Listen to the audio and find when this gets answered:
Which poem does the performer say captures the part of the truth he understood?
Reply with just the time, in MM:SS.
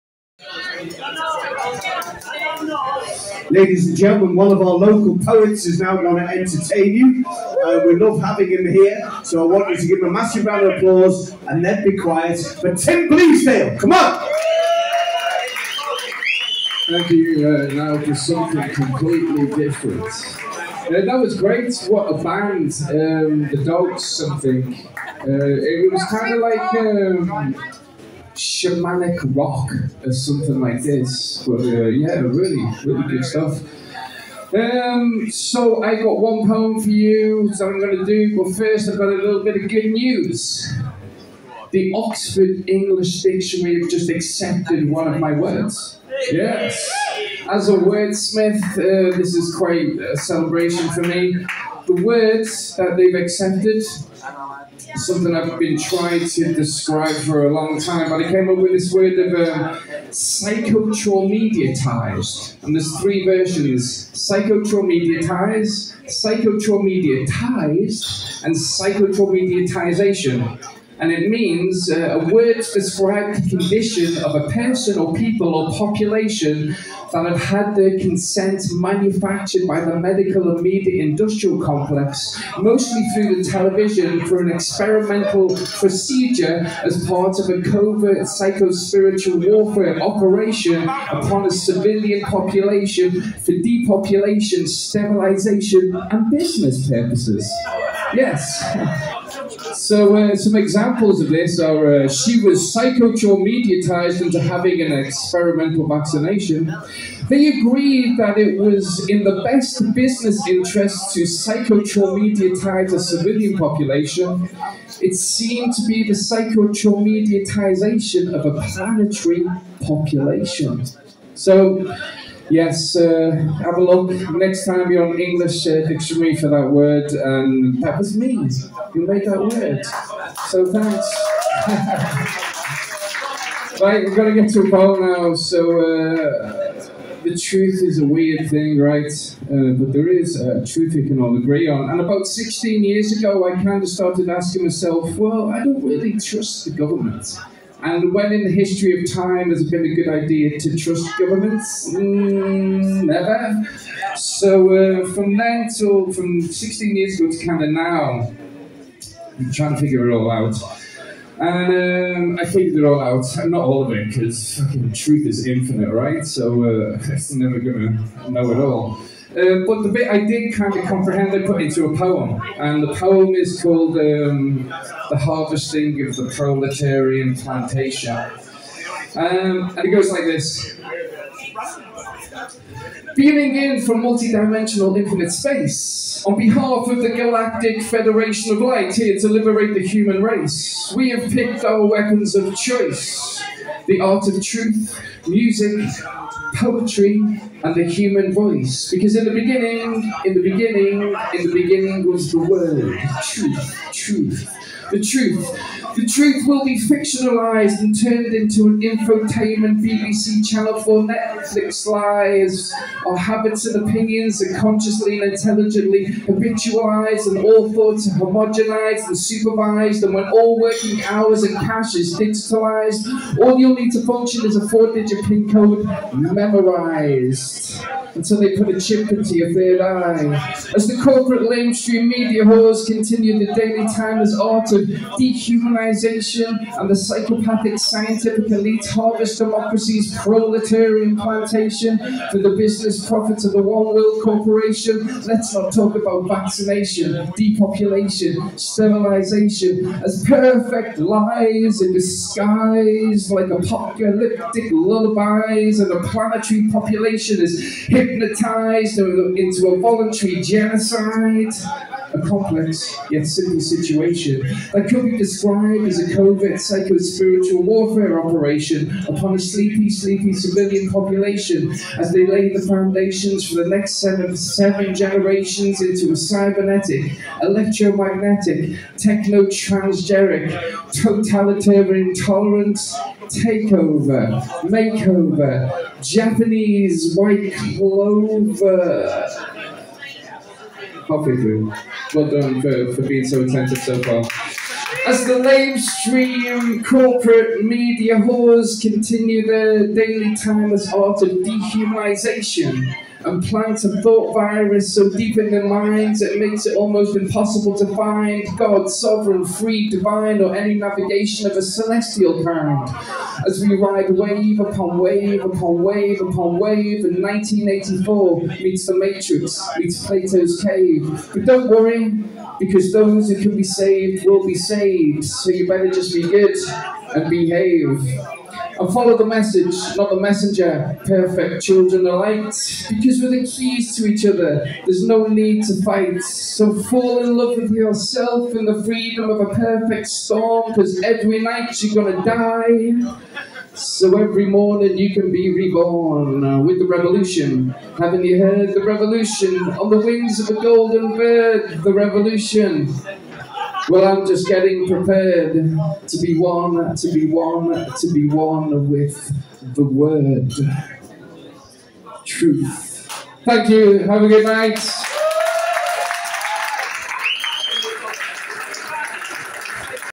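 02:55.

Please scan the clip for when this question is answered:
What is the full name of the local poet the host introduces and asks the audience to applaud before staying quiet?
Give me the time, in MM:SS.
00:12.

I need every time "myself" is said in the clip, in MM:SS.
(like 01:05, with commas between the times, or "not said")
02:24.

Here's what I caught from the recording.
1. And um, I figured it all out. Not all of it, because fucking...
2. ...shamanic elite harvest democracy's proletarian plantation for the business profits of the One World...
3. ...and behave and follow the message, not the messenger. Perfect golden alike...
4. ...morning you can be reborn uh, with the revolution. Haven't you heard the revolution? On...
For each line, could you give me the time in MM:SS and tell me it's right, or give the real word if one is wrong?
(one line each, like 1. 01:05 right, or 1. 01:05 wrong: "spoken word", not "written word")
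1. 02:41 right
2. 03:57 wrong: "scientific", not "shamanic"
3. 05:27 wrong: "children", not "golden"
4. 05:44 right.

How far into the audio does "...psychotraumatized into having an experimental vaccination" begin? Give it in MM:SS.
01:42.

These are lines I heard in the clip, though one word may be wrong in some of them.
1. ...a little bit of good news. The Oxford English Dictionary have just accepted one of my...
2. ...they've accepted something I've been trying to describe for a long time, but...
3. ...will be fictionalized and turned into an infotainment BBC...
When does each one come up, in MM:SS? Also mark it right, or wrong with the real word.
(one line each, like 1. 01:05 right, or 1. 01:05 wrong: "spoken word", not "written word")
1. 00:39 right
2. 00:52 right
3. 03:26 right.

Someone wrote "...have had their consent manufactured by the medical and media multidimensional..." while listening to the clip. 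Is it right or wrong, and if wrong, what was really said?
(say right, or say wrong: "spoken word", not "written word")
wrong: "industrial", not "multidimensional".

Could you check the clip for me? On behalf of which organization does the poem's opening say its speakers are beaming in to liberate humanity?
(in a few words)
Galactic Federation of Light.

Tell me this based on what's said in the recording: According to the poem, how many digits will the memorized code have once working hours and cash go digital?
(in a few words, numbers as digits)
4.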